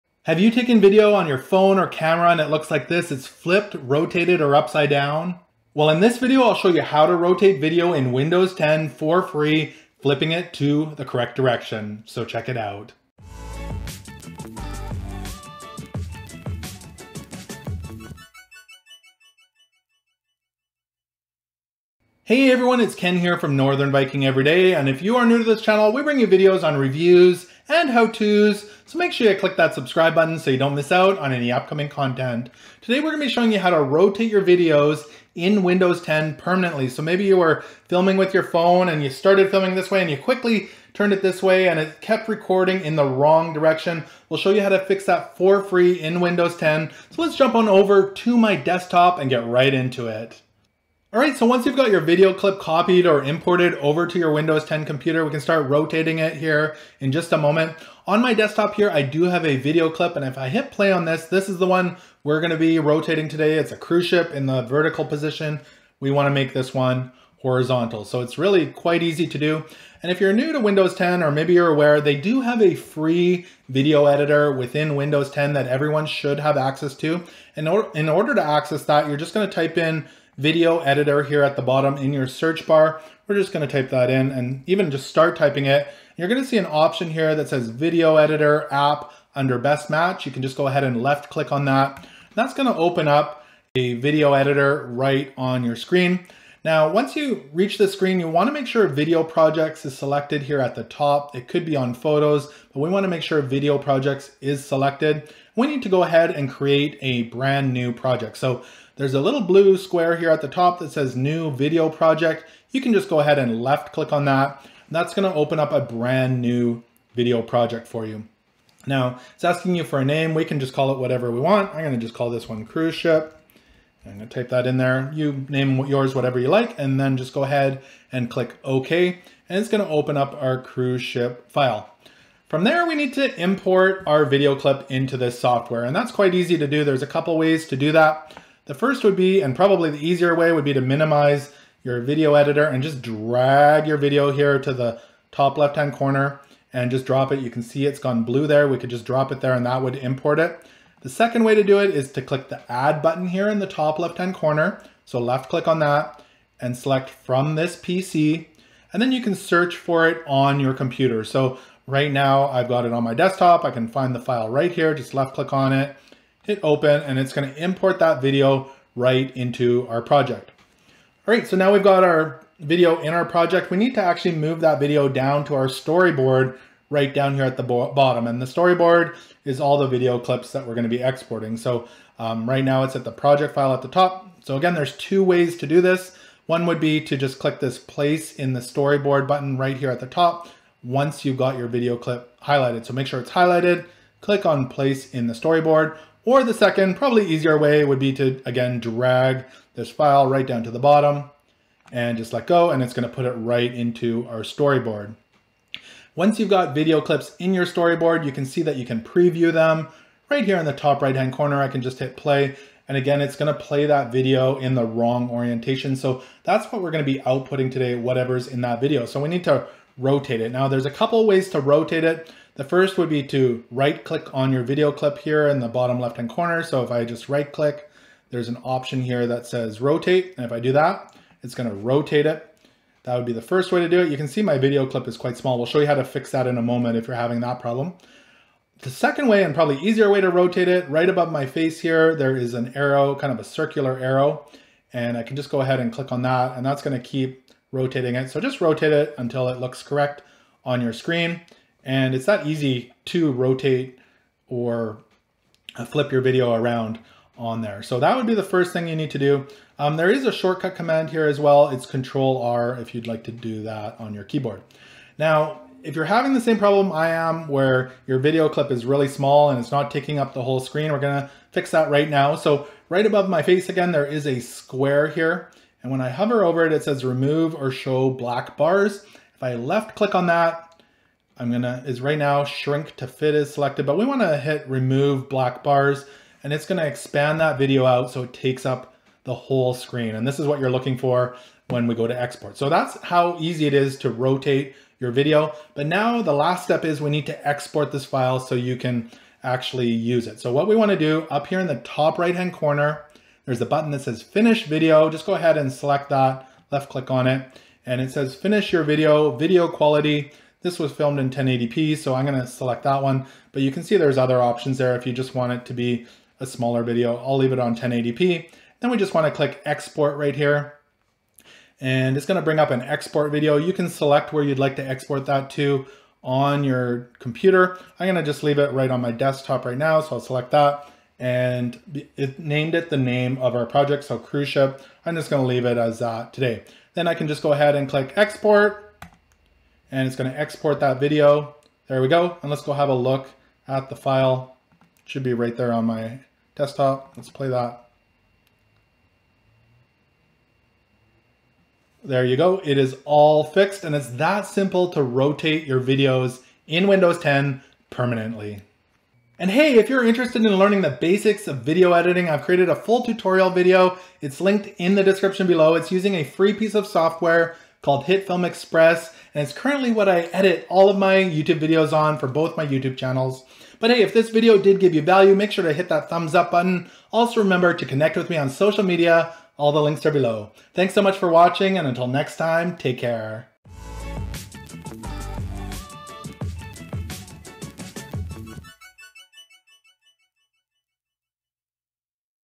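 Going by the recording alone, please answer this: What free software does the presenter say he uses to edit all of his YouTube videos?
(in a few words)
HitFilm Express.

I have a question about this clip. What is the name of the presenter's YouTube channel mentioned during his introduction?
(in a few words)
Northern Viking Everyday.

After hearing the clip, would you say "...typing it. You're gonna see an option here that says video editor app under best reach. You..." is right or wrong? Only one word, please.
wrong.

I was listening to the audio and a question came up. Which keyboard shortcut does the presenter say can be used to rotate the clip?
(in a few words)
Control R.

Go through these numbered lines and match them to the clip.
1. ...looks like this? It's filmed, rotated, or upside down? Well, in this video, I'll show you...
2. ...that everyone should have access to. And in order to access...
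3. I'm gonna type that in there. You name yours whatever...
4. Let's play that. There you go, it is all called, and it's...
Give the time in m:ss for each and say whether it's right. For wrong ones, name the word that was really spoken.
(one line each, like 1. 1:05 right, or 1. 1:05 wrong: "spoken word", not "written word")
1. 0:02 wrong: "flipped", not "filmed"
2. 1:15 right
3. 2:04 right
4. 5:47 wrong: "fixed", not "called".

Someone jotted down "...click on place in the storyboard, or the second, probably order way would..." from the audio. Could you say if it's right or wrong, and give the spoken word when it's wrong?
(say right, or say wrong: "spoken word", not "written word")
wrong: "easier", not "order".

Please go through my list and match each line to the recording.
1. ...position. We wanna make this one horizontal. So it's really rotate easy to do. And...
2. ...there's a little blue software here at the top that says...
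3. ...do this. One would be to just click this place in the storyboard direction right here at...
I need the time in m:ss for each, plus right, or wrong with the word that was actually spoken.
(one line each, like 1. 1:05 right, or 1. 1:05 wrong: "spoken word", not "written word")
1. 1:05 wrong: "quite", not "rotate"
2. 1:49 wrong: "square", not "software"
3. 3:05 wrong: "button", not "direction".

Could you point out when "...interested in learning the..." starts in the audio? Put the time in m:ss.
6:00.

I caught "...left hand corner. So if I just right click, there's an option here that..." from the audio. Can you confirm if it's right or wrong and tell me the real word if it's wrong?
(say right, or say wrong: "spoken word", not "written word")
right.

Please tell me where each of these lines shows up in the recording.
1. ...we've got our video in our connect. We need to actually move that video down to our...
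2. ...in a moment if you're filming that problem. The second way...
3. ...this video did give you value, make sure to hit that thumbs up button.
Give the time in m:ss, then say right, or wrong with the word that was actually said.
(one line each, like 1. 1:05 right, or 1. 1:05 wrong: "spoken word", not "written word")
1. 2:51 wrong: "project", not "connect"
2. 3:56 wrong: "having", not "filming"
3. 6:14 right.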